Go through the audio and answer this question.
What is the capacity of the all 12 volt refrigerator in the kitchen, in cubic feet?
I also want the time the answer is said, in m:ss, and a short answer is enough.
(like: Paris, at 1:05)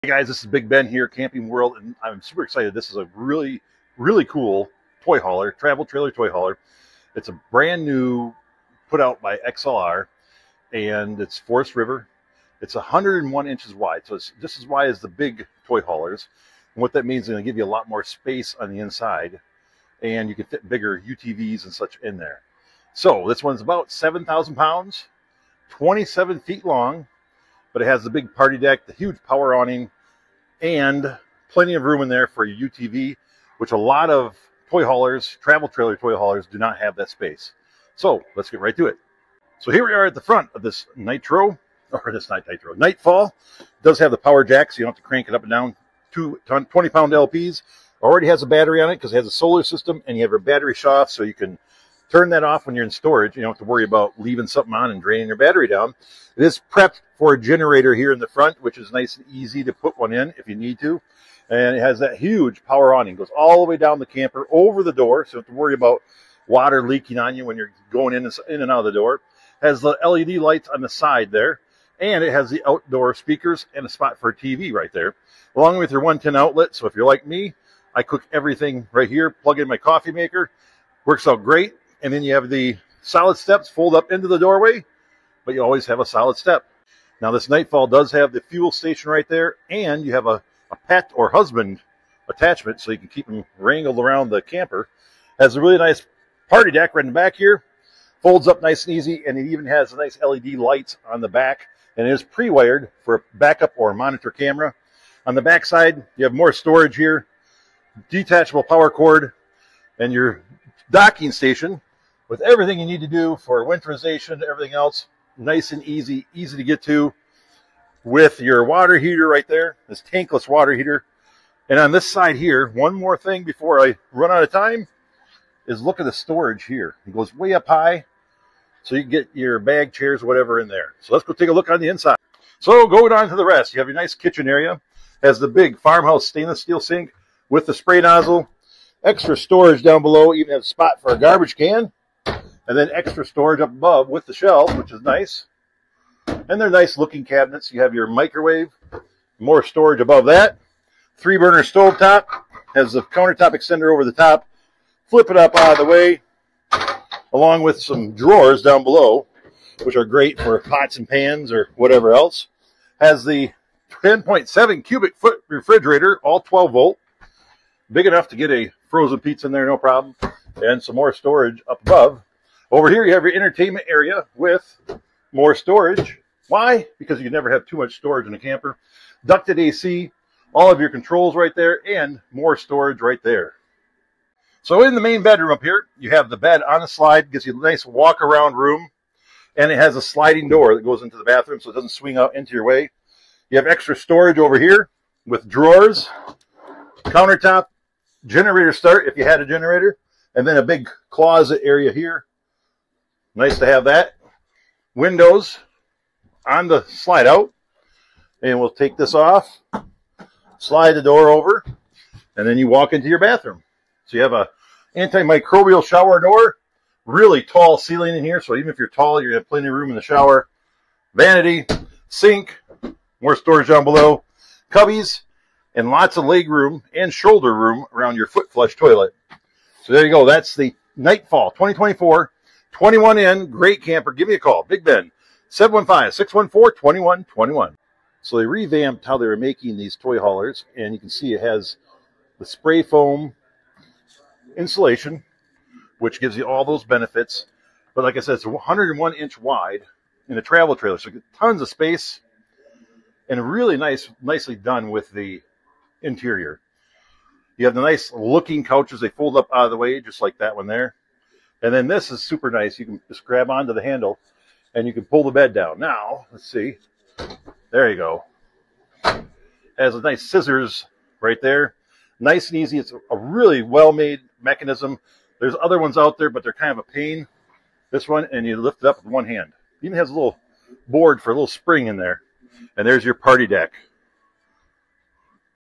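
10.7, at 2:44.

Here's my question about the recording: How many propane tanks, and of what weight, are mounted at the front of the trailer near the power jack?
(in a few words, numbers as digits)
Two 20 pound.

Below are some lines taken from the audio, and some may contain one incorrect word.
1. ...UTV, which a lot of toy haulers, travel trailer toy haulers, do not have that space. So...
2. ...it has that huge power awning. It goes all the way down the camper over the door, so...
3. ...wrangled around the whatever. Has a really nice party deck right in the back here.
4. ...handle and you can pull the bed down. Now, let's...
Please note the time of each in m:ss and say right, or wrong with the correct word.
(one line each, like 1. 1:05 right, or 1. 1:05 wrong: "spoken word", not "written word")
1. 0:32 right
2. 1:01 right
3. 1:33 wrong: "camper", not "whatever"
4. 4:23 right.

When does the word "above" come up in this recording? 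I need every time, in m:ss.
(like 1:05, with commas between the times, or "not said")
2:23, 2:29, 2:51.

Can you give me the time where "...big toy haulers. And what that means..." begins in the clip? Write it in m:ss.
0:15.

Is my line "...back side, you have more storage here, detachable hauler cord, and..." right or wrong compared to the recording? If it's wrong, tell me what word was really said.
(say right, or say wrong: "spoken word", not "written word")
wrong: "power", not "hauler".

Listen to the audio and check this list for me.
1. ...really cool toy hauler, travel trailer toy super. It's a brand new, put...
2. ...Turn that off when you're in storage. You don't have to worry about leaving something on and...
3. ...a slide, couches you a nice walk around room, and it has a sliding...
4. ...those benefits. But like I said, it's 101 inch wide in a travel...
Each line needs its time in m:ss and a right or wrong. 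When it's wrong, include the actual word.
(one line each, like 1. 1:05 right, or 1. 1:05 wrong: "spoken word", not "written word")
1. 0:03 wrong: "hauler", not "super"
2. 0:52 right
3. 3:06 wrong: "gives", not "couches"
4. 4:06 right.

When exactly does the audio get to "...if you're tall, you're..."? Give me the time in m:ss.
3:38.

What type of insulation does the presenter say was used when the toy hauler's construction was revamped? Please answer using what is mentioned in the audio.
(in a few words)
spray foam insulation.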